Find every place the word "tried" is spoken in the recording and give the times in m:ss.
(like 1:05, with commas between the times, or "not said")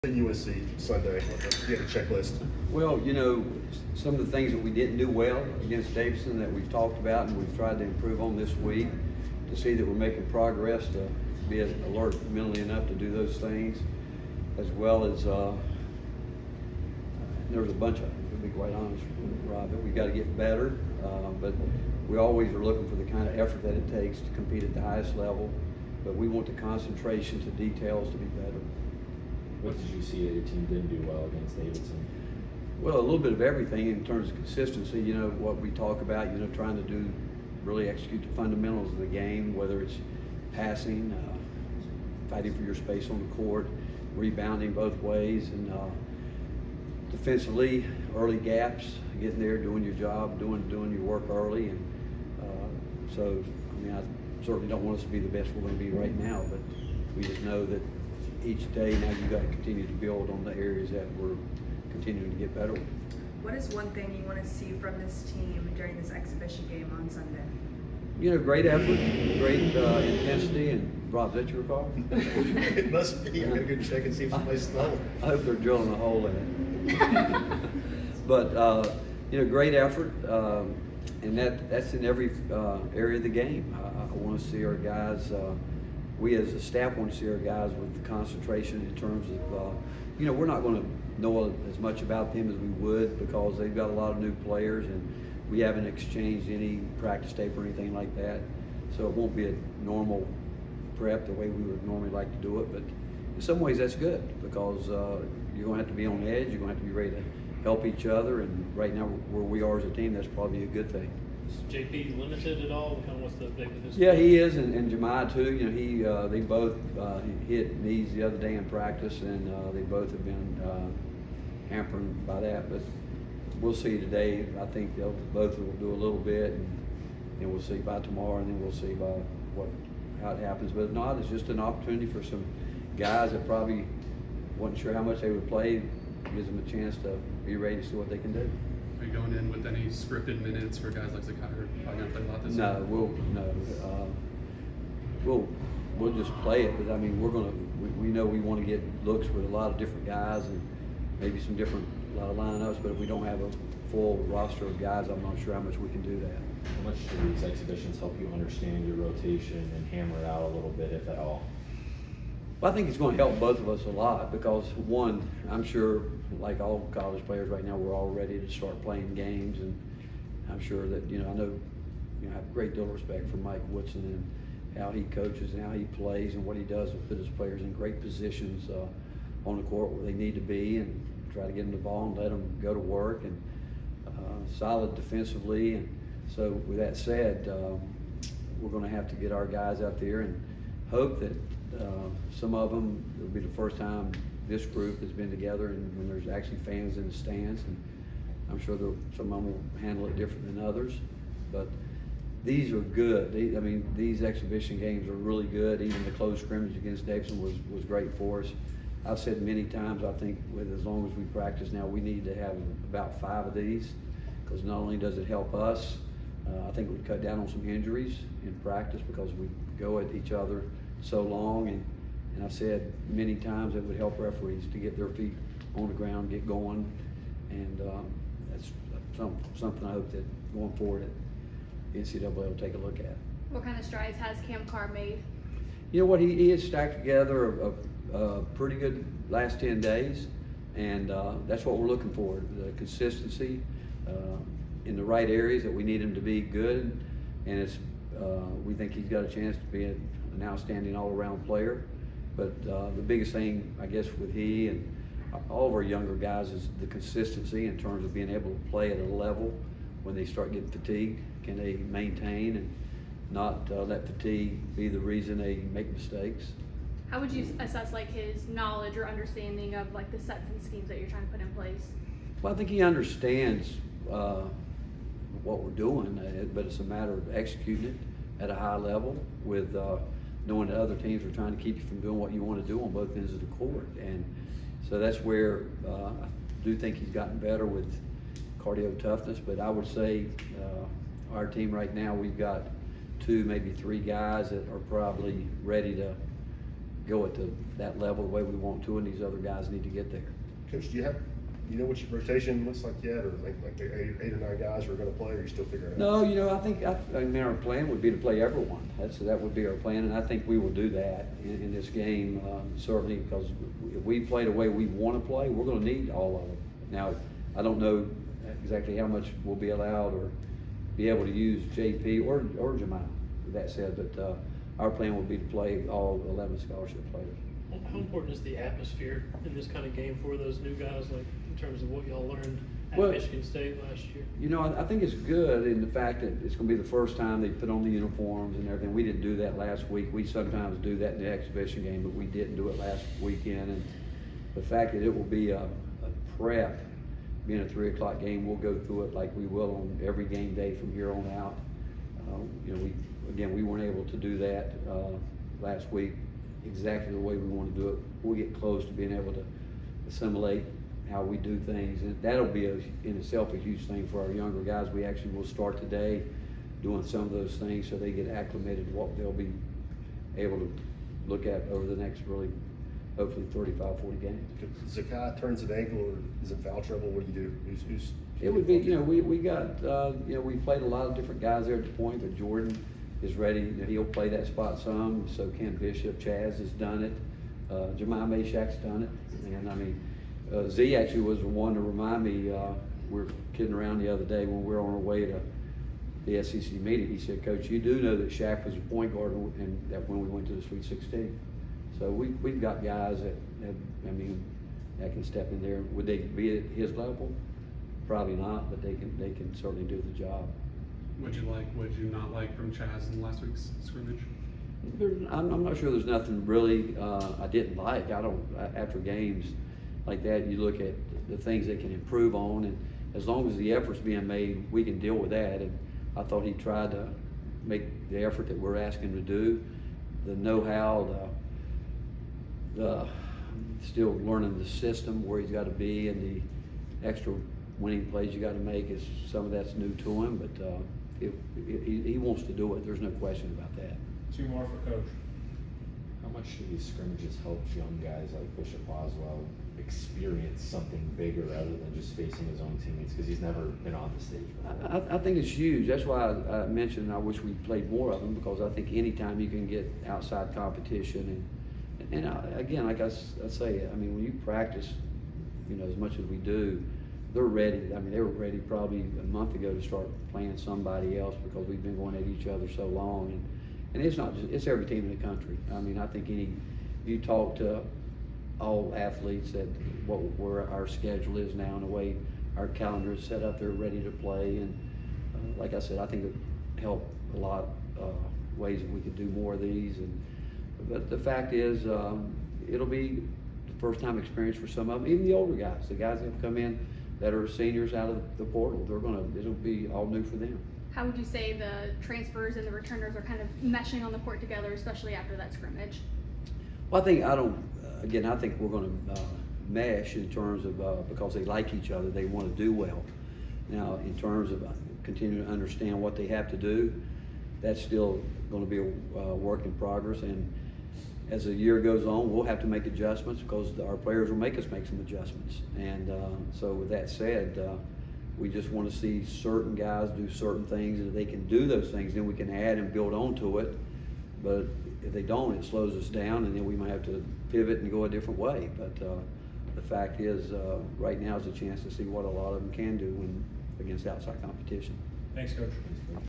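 0:07, 7:06.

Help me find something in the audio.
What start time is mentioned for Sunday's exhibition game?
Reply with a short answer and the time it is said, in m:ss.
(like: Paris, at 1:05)
3:00, at 5:47.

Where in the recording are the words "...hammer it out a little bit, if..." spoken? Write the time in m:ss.
2:39.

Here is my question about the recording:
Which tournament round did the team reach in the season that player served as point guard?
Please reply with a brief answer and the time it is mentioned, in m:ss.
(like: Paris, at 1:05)
Sweet 16, at 6:40.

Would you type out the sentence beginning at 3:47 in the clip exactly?
And um, that's some, something I hope that going forward that NCAA will take a look at.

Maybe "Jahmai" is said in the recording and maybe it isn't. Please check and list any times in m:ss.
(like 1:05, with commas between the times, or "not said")
1:54, 5:22, 6:27.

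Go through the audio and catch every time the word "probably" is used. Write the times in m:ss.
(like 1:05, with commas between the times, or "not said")
1:50, 2:13, 2:21, 4:54, 6:48, 7:48.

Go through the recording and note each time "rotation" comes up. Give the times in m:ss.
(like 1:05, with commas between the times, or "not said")
2:38, 5:02.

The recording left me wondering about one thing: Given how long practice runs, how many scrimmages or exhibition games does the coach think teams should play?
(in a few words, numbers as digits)
5.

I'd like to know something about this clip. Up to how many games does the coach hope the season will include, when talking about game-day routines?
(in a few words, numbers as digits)
35 to 40.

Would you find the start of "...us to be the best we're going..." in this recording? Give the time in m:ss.
0:54.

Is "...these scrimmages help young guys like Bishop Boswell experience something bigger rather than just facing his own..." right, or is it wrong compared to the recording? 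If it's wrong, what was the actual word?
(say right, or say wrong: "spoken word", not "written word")
right.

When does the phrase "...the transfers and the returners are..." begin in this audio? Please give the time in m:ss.
8:21.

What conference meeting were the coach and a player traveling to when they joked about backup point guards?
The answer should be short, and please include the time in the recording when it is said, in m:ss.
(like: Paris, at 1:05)
SEC, at 6:36.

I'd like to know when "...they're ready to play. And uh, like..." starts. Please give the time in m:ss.
8:03.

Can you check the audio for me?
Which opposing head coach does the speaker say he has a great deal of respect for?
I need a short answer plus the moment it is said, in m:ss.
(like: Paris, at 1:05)
Mike Woodson, at 2:53.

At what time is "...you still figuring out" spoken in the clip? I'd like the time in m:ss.
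5:05.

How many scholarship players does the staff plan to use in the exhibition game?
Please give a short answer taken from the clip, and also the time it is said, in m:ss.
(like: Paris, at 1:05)
11, at 5:26.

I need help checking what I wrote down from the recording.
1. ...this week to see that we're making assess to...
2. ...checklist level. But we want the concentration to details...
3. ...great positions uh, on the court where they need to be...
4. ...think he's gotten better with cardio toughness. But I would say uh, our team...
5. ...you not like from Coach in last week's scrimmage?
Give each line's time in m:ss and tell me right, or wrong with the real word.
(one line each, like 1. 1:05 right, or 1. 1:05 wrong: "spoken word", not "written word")
1. 0:08 wrong: "progress", not "assess"
2. 0:24 wrong: "highest", not "checklist"
3. 2:57 right
4. 4:46 right
5. 6:51 wrong: "Chaz", not "Coach".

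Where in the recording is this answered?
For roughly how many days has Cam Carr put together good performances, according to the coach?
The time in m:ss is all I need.
3:59.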